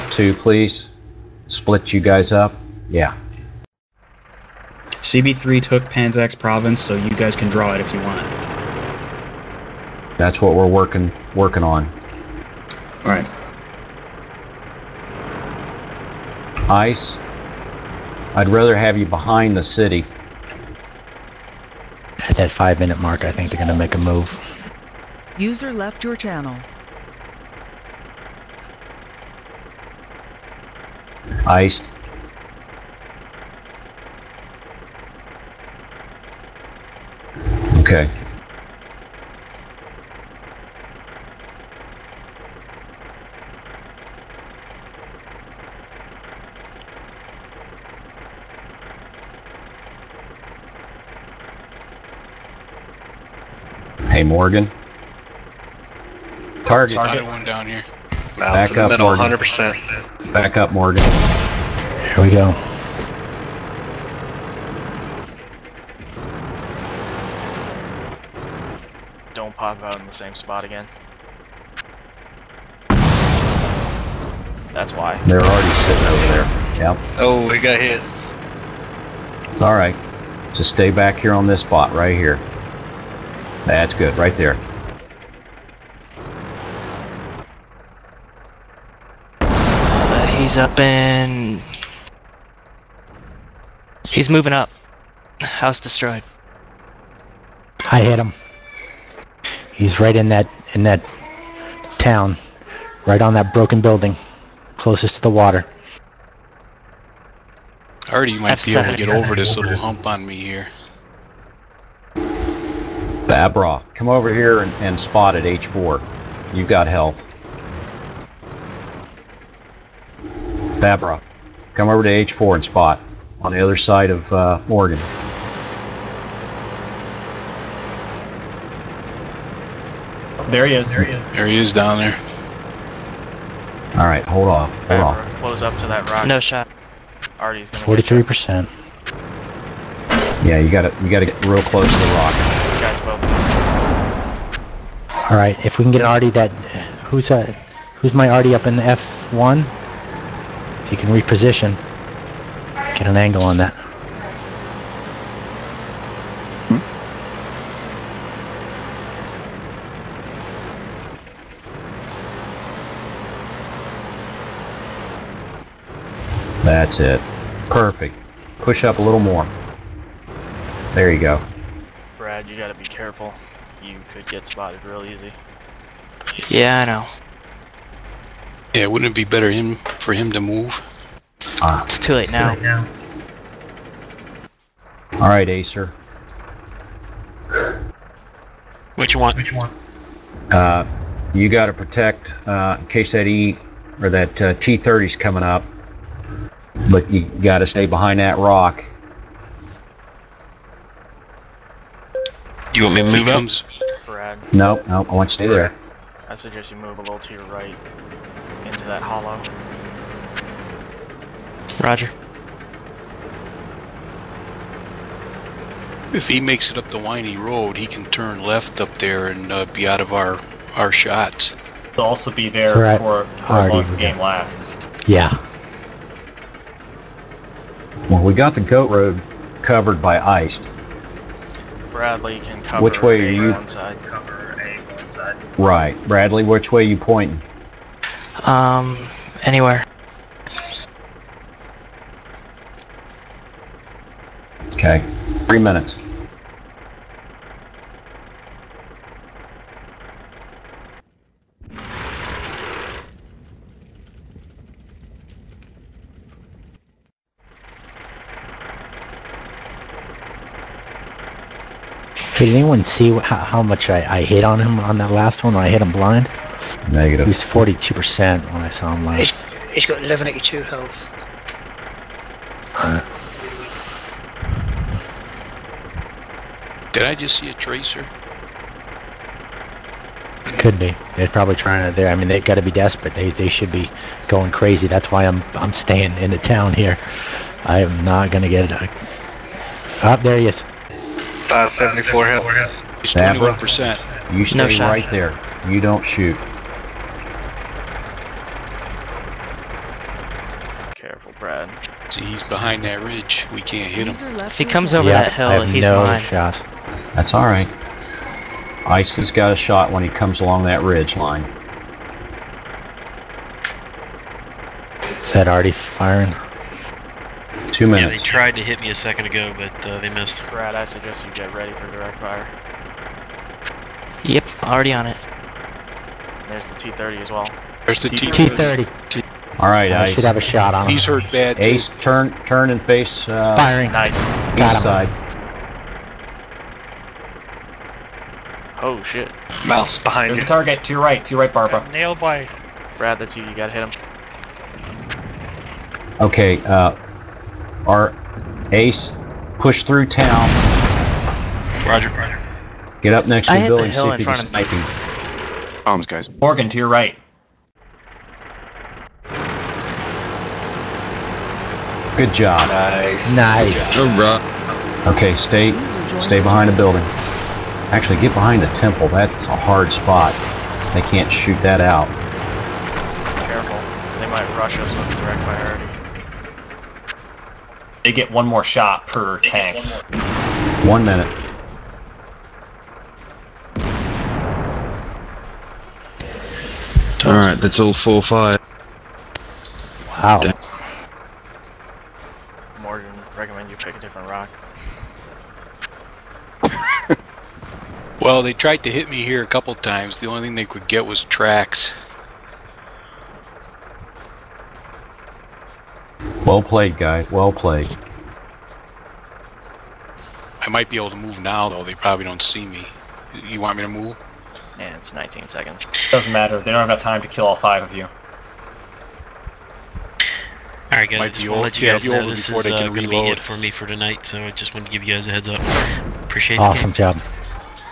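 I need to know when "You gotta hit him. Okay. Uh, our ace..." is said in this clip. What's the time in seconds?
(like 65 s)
343 s.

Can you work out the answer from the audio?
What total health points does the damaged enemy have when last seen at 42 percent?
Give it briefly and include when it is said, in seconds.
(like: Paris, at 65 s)
1182, at 270 s.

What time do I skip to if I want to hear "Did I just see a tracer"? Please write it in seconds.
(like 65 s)
276 s.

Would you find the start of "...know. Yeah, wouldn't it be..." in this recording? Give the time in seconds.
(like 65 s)
176 s.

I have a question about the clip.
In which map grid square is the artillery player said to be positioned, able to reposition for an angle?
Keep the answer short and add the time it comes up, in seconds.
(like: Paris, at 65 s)
F1, at 148 s.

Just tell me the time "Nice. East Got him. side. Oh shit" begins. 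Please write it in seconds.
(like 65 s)
333 s.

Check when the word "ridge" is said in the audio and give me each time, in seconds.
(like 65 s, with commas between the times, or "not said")
303 s, 310 s.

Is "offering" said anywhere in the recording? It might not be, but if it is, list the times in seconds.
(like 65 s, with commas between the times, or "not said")
not said.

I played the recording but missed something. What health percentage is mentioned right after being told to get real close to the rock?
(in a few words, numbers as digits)
43%.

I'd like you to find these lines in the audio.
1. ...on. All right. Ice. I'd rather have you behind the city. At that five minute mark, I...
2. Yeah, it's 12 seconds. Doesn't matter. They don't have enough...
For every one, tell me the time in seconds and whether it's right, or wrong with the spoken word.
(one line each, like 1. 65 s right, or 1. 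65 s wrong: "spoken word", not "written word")
1. 11 s right
2. 414 s wrong: "19", not "12".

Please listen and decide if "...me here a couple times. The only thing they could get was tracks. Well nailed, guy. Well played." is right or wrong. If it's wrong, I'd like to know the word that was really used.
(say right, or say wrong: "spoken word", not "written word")
wrong: "played", not "nailed".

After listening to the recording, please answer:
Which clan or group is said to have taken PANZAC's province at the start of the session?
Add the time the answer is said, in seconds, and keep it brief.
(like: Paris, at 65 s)
CB3, at 5 s.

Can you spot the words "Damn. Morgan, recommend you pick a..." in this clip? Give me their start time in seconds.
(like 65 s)
390 s.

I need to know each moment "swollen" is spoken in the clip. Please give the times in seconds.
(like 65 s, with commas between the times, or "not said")
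not said.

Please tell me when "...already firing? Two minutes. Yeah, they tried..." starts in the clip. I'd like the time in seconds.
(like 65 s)
315 s.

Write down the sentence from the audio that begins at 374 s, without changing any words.
They might rush us with direct priority.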